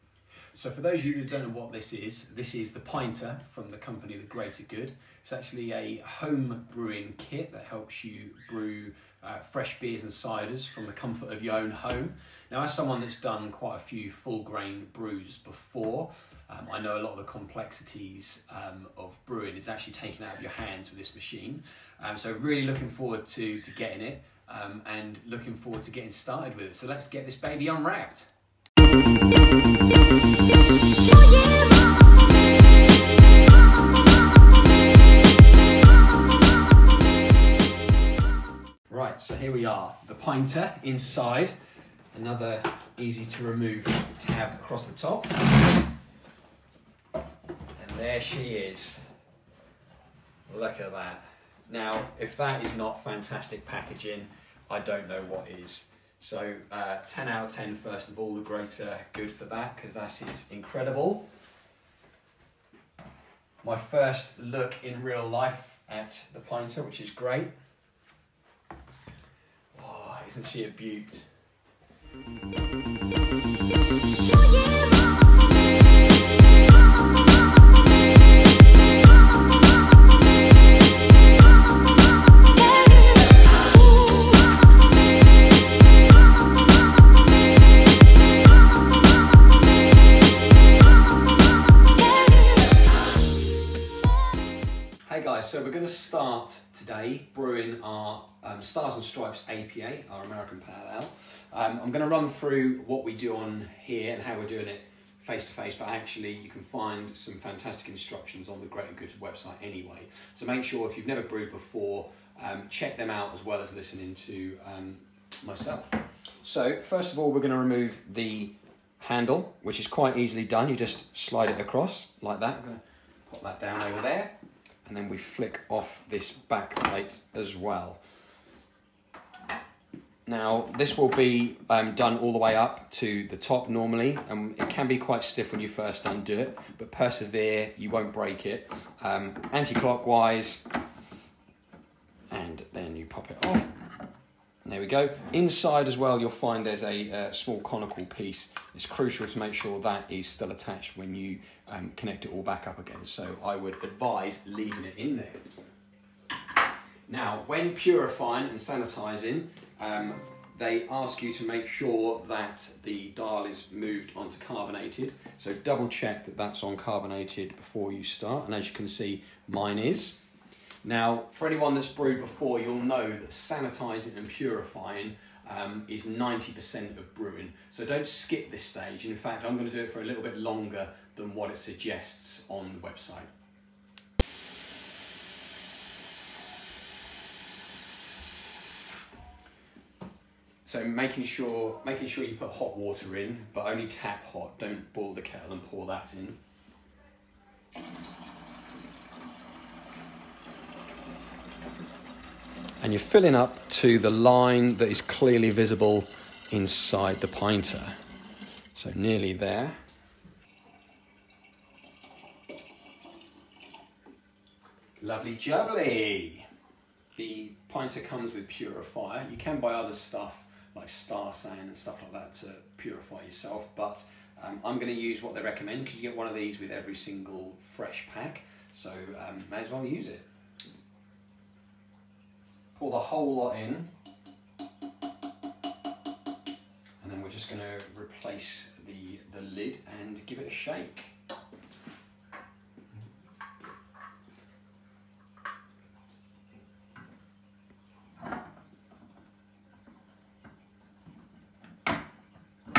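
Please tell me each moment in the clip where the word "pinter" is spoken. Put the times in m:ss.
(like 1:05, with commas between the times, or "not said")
0:02, 0:40, 1:06, 3:27, 3:37.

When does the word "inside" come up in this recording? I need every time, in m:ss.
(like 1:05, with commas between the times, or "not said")
0:40, 2:25, 3:26.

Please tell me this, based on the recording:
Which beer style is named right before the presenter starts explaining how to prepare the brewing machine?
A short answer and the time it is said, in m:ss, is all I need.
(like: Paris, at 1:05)
American Pale Ale, at 1:40.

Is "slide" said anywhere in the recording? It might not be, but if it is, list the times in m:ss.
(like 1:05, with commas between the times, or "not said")
2:01.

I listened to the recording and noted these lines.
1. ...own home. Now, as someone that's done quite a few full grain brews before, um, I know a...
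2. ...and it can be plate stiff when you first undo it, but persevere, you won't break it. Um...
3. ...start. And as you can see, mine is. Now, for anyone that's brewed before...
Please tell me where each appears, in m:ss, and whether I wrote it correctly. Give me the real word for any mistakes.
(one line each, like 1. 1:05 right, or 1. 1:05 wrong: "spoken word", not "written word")
1. 0:11 right
2. 2:14 wrong: "quite", not "plate"
3. 2:48 right.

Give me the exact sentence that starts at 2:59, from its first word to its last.
In fact, I'm gonna do it for a little bit longer than what it suggests on the website.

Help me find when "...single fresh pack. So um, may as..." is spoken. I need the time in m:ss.
3:46.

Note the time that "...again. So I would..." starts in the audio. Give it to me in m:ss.
2:32.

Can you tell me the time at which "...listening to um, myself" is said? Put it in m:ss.
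1:53.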